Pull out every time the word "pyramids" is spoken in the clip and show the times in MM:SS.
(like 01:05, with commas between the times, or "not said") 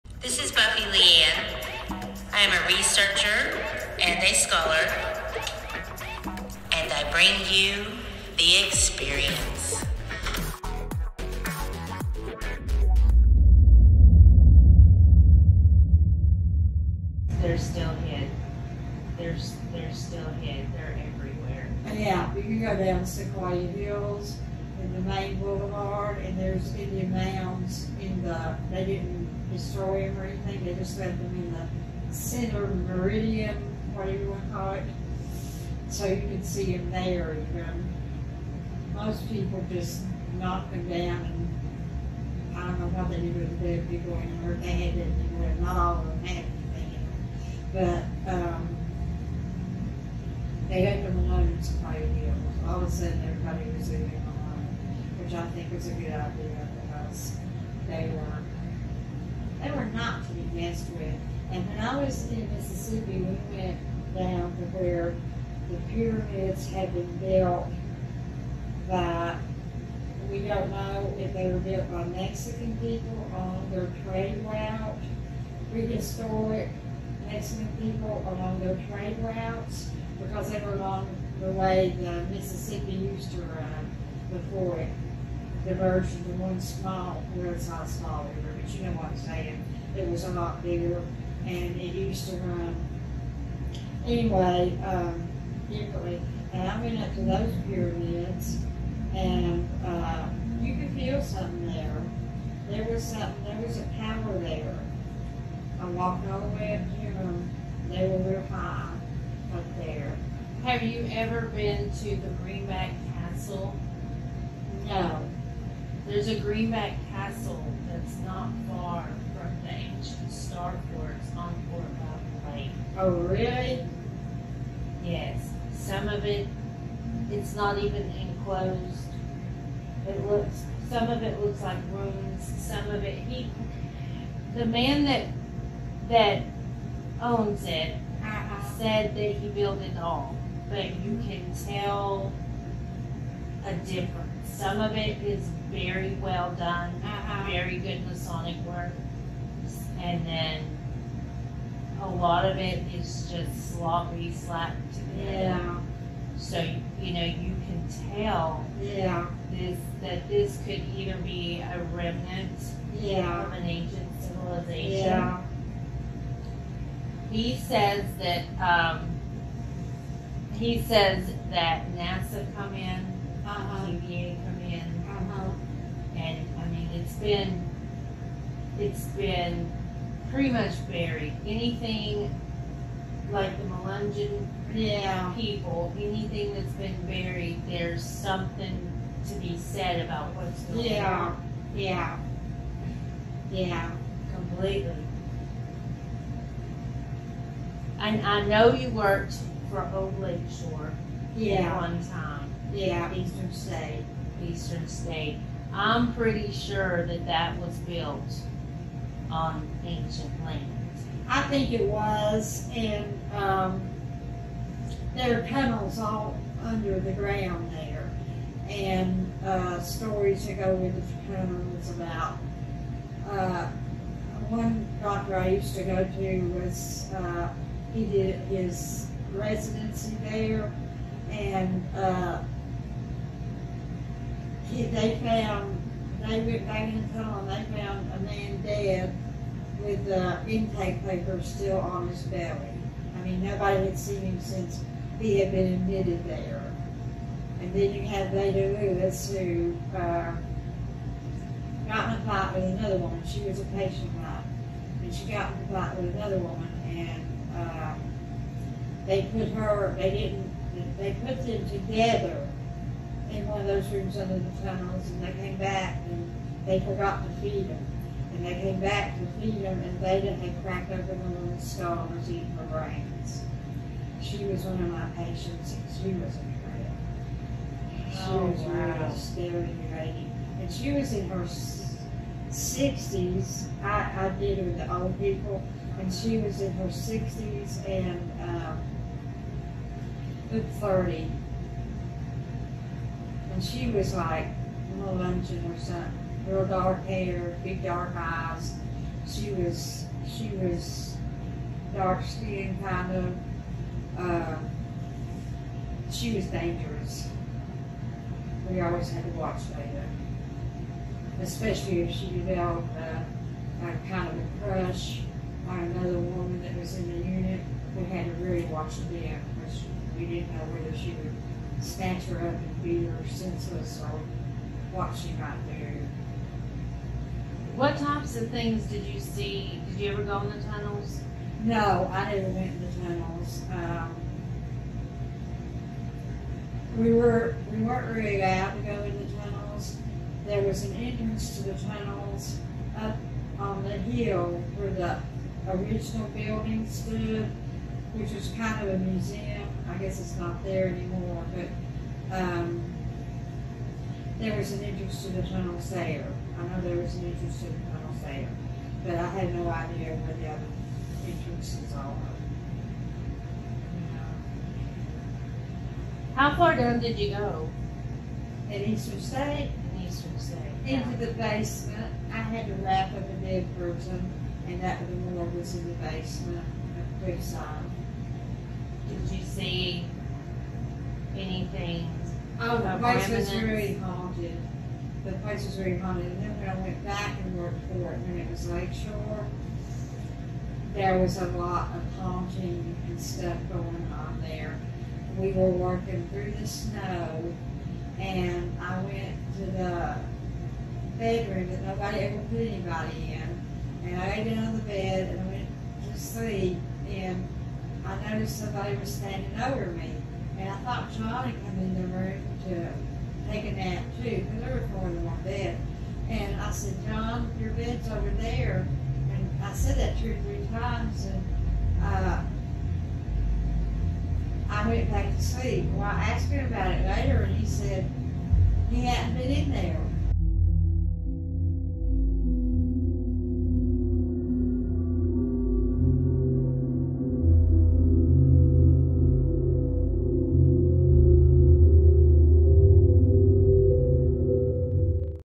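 01:05, 01:37.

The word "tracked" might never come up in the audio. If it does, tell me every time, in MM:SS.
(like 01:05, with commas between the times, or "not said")
not said.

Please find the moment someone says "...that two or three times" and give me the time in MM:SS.
06:59.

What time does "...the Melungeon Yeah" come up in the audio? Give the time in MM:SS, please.
03:03.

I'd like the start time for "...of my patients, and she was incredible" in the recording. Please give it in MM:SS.
04:34.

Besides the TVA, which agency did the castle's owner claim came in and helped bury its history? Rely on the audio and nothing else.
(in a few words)
NASA.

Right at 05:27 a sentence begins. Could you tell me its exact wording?
What types of things did you see?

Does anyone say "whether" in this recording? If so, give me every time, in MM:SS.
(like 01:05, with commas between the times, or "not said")
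05:20.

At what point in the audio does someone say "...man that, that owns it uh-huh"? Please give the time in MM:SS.
02:14.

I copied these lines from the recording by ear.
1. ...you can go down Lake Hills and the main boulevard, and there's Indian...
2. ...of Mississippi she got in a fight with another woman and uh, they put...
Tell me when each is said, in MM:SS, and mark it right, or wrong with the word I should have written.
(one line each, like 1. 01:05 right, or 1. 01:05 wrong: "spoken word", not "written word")
1. 00:22 wrong: "Sequoyah", not "Lake"
2. 04:14 wrong: "And", not "Mississippi".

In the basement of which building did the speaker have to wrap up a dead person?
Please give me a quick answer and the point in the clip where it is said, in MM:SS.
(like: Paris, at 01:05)
Creekside, at 06:17.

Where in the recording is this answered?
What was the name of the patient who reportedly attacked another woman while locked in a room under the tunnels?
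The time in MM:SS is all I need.
04:08.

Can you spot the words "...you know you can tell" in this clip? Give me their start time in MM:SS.
02:37.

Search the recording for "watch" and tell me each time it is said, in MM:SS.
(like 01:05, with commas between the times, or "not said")
05:09, 05:18.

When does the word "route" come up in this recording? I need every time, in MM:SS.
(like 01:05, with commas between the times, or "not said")
01:14, 01:19.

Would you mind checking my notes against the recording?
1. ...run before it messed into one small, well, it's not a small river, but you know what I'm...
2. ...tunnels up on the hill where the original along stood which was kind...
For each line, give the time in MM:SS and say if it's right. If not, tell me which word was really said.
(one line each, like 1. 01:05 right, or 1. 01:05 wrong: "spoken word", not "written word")
1. 01:23 wrong: "diverged", not "messed"
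2. 05:41 wrong: "building", not "along".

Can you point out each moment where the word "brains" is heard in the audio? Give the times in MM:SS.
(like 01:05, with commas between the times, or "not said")
04:32.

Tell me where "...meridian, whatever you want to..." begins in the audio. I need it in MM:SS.
00:32.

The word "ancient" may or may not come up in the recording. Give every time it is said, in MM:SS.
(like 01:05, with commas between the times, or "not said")
01:59, 02:43, 03:29.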